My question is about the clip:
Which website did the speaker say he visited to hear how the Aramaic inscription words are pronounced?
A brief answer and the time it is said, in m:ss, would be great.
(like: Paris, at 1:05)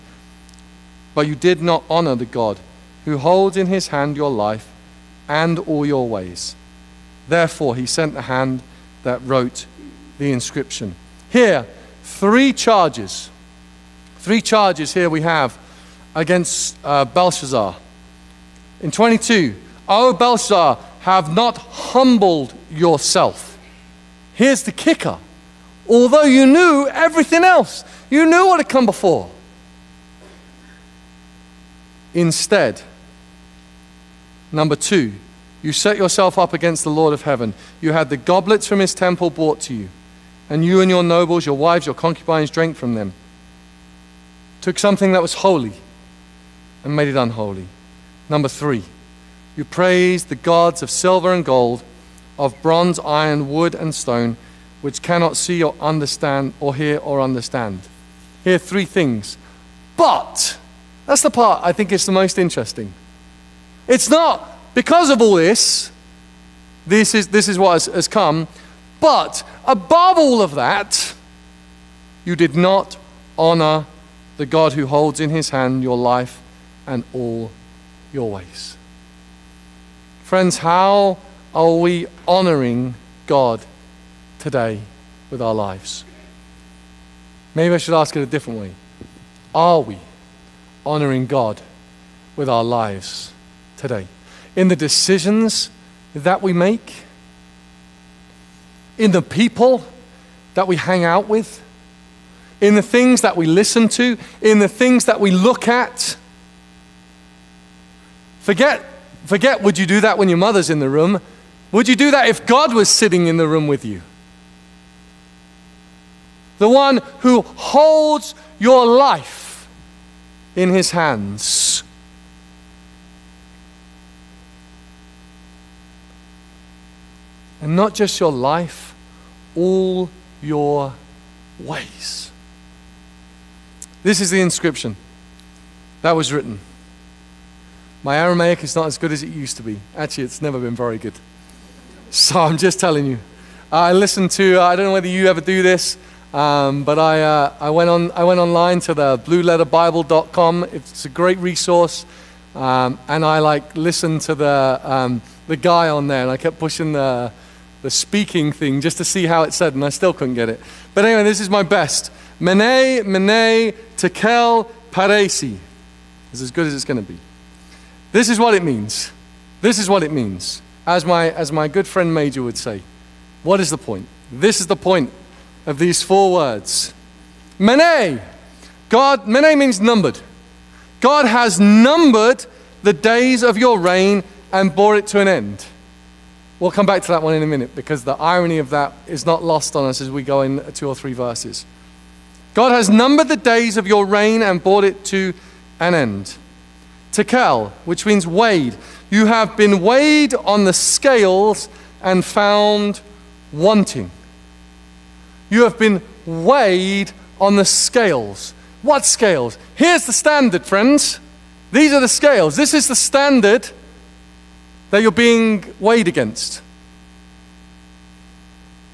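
blueletterbible.com, at 2:29.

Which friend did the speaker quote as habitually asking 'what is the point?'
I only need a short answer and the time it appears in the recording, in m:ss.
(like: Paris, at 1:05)
Major, at 2:52.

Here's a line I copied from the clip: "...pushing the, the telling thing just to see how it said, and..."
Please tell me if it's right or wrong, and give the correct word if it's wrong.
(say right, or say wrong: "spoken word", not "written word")
wrong: "speaking", not "telling".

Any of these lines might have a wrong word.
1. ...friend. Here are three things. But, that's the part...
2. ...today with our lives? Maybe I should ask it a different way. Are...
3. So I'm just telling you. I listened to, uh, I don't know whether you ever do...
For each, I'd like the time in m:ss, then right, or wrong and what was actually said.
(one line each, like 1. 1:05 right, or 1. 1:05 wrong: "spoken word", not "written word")
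1. 0:57 wrong: "understand", not "friend"
2. 1:24 right
3. 2:22 right.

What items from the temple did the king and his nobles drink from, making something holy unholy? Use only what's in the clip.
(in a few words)
Goblets.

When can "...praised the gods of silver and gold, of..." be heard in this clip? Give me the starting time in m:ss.
0:49.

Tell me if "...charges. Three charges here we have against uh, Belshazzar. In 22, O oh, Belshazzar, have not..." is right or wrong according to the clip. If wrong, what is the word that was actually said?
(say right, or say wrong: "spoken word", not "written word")
right.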